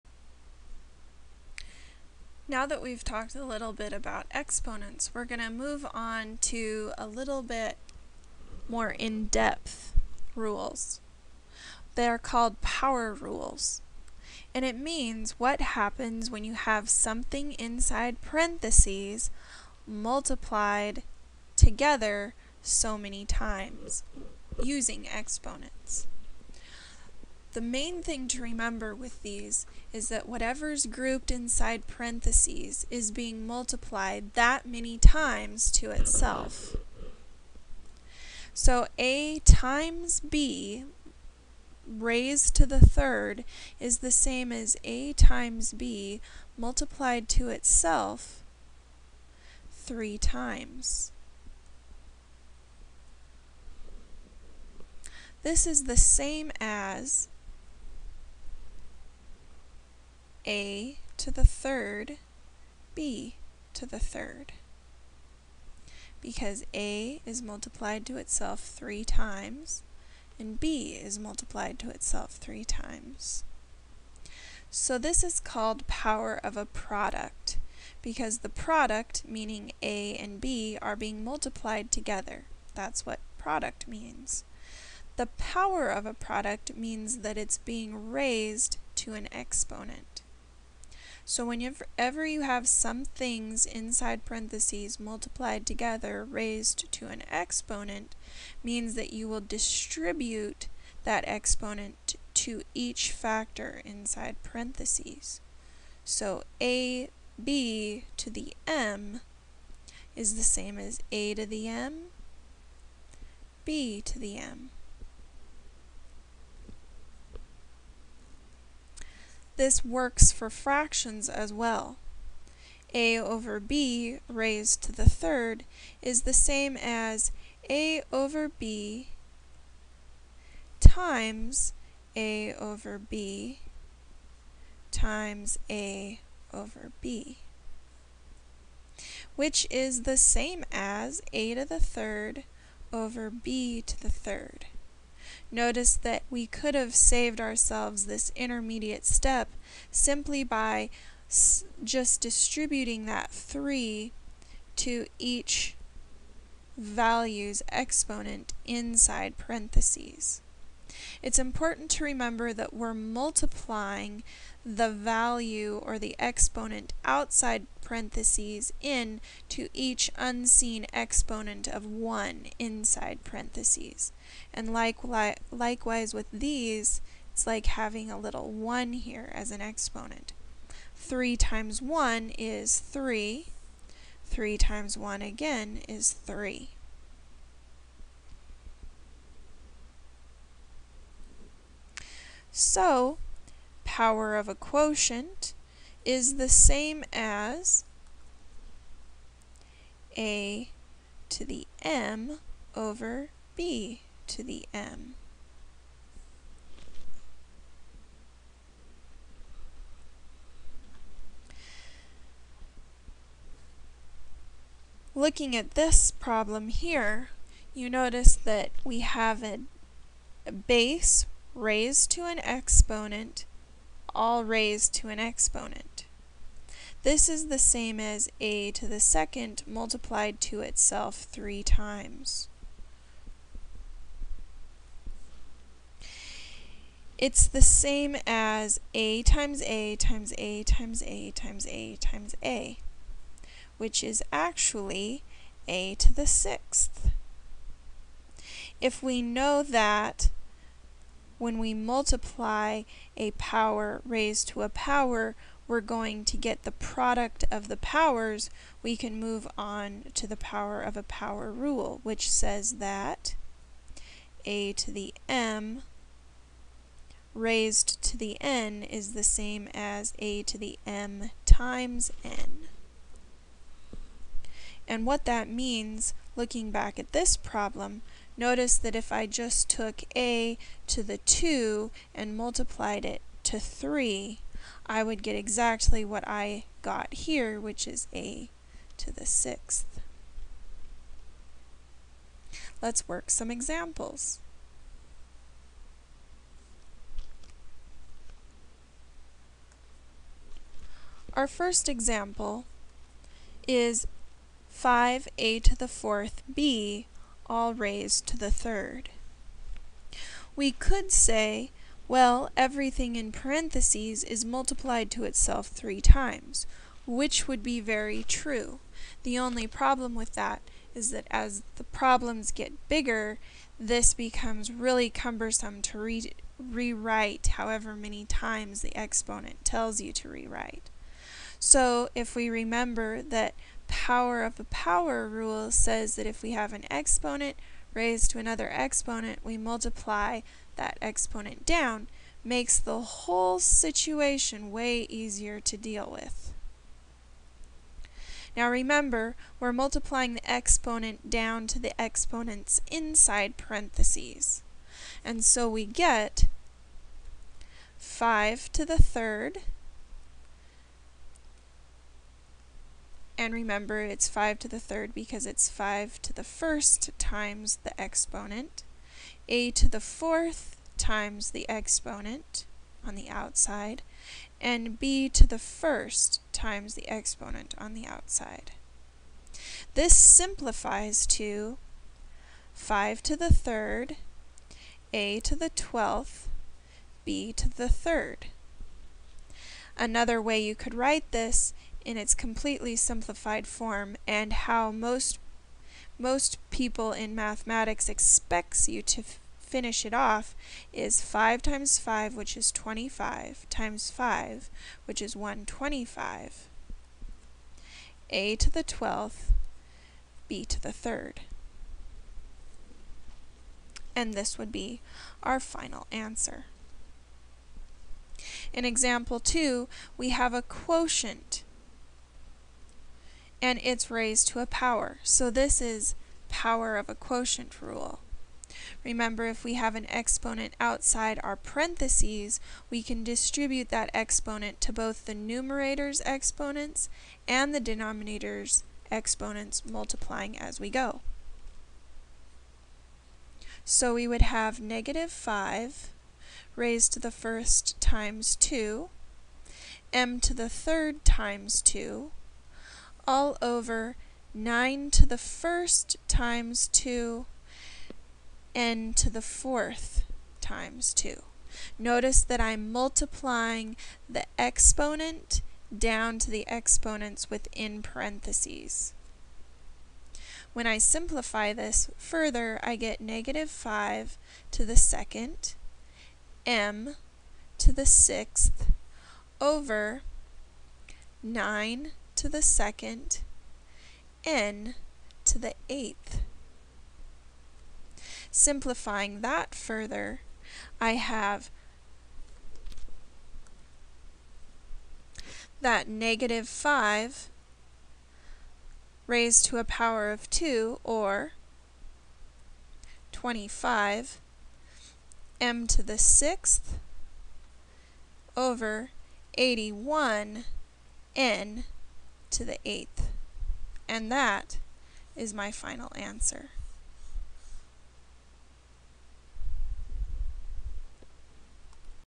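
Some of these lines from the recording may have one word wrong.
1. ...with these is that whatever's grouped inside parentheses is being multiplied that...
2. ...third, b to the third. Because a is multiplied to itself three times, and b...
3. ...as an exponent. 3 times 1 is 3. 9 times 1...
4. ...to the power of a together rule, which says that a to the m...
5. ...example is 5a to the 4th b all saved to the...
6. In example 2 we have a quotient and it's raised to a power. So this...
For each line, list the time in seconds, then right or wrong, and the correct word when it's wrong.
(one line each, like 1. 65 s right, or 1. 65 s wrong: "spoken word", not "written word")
1. 28 s right
2. 61 s right
3. 179 s wrong: "3", not "9"
4. 260 s wrong: "power", not "together"
5. 301 s wrong: "raised", not "saved"
6. 418 s right.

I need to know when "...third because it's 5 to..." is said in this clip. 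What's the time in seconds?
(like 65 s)
364 s.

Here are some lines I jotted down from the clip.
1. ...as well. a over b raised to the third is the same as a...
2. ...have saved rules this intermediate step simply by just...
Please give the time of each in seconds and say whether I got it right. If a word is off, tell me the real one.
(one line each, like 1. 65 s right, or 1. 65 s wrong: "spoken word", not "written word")
1. 121 s right
2. 146 s wrong: "ourselves", not "rules".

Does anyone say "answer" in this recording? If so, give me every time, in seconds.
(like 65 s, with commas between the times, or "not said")
416 s, 516 s.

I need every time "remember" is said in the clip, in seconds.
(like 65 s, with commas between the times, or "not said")
28 s, 162 s, 332 s, 348 s, 363 s, 429 s.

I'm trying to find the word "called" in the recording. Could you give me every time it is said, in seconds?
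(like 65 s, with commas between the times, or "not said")
12 s, 75 s.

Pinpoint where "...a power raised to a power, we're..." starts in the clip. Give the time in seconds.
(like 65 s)
253 s.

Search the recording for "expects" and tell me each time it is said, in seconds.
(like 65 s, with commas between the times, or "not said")
398 s.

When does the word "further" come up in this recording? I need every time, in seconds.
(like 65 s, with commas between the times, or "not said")
472 s, 489 s.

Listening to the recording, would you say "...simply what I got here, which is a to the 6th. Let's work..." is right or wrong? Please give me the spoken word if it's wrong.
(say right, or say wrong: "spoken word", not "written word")
wrong: "exactly", not "simply".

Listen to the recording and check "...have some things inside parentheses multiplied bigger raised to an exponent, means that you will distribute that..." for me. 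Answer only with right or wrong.
wrong.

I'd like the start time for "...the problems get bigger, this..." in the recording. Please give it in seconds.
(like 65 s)
321 s.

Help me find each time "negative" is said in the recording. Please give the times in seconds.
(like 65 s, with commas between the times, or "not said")
444 s, 473 s, 496 s.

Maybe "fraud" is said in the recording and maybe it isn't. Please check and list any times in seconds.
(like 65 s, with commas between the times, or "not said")
not said.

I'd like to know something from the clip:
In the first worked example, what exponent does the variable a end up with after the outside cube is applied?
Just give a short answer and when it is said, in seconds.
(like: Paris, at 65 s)
12, at 385 s.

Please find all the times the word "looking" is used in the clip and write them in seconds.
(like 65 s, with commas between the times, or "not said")
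215 s, 276 s.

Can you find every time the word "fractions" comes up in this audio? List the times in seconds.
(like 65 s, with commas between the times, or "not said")
120 s.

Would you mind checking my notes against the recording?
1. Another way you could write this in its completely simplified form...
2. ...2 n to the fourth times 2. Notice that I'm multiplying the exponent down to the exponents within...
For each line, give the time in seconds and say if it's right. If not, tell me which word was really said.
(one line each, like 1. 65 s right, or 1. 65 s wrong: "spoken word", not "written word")
1. 389 s right
2. 456 s right.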